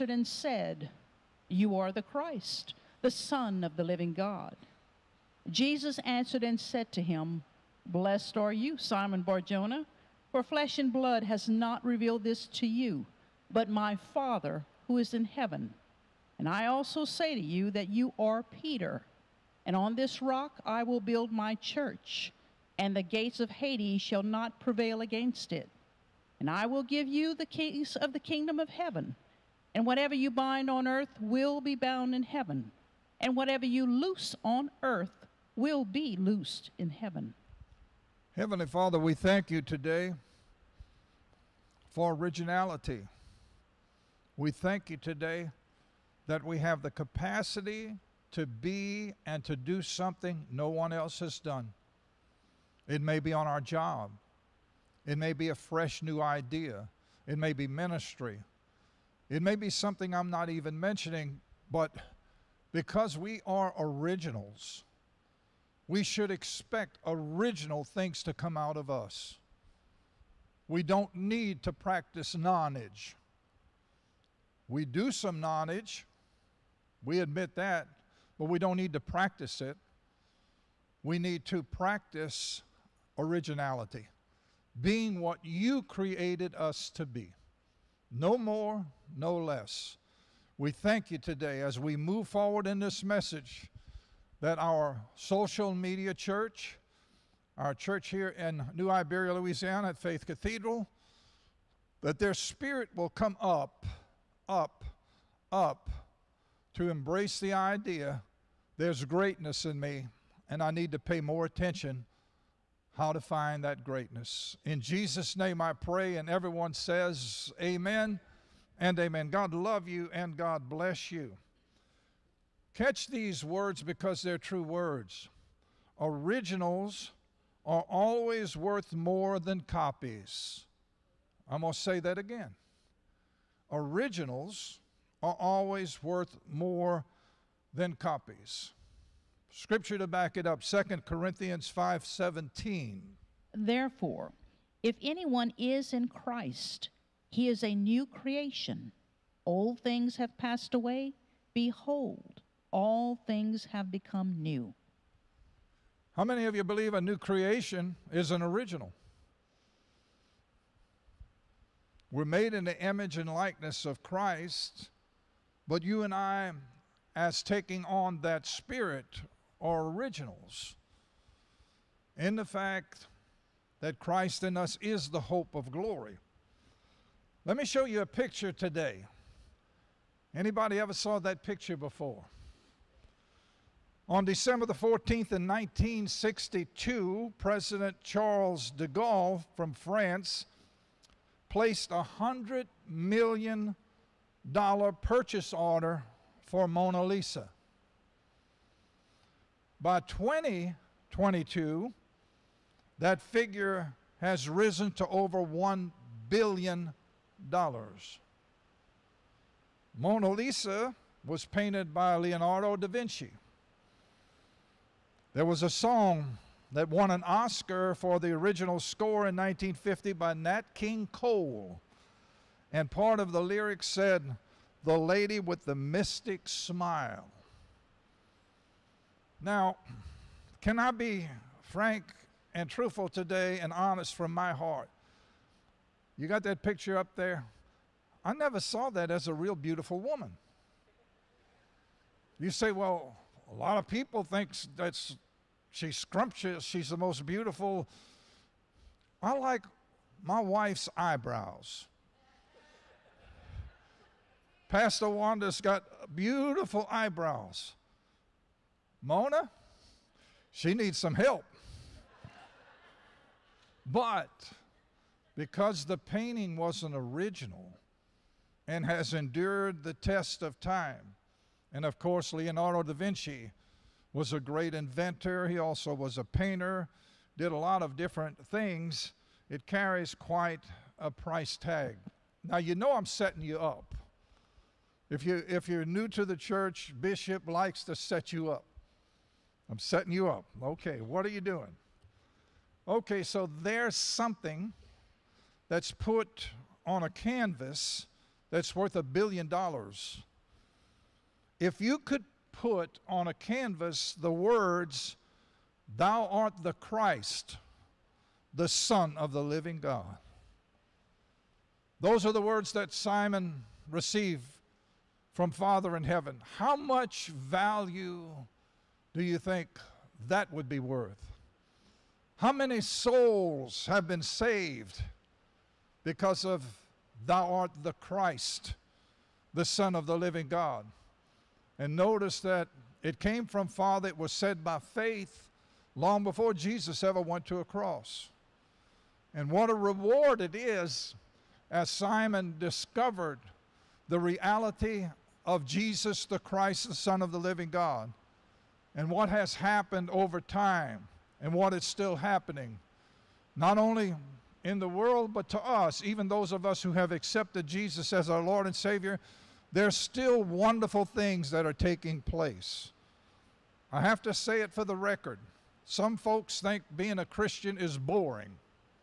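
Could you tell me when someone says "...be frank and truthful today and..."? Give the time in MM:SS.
03:50.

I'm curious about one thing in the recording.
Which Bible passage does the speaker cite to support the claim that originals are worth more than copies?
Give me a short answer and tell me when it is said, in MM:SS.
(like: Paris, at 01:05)
2 Corinthians 5:17, at 02:20.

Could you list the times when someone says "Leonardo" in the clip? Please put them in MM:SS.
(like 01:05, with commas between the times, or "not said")
03:32, 04:32.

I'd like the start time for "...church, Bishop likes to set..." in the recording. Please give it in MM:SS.
04:46.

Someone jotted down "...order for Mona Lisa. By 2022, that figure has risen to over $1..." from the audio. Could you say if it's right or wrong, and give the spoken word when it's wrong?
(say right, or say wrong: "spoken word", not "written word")
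right.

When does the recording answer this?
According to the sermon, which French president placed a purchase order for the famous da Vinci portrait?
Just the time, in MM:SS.
03:08.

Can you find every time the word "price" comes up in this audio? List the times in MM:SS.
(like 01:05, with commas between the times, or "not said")
04:41.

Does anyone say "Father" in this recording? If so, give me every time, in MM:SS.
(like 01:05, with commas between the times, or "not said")
00:14, 00:38, 05:15, 05:33.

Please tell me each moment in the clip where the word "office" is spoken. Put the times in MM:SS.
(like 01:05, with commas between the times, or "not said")
not said.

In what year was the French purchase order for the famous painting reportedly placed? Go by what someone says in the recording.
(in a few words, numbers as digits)
1962.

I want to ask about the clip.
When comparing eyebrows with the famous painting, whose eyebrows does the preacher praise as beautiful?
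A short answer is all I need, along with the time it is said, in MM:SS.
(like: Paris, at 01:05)
Pastor Wanda, at 04:14.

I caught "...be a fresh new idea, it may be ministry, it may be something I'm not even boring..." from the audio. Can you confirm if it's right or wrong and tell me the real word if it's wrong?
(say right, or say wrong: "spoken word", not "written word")
wrong: "mentioning", not "boring".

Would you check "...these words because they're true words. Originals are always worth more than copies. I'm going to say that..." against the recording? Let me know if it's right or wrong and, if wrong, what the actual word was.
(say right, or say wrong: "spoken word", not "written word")
right.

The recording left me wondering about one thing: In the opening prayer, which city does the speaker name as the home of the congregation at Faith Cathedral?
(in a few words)
New Iberia.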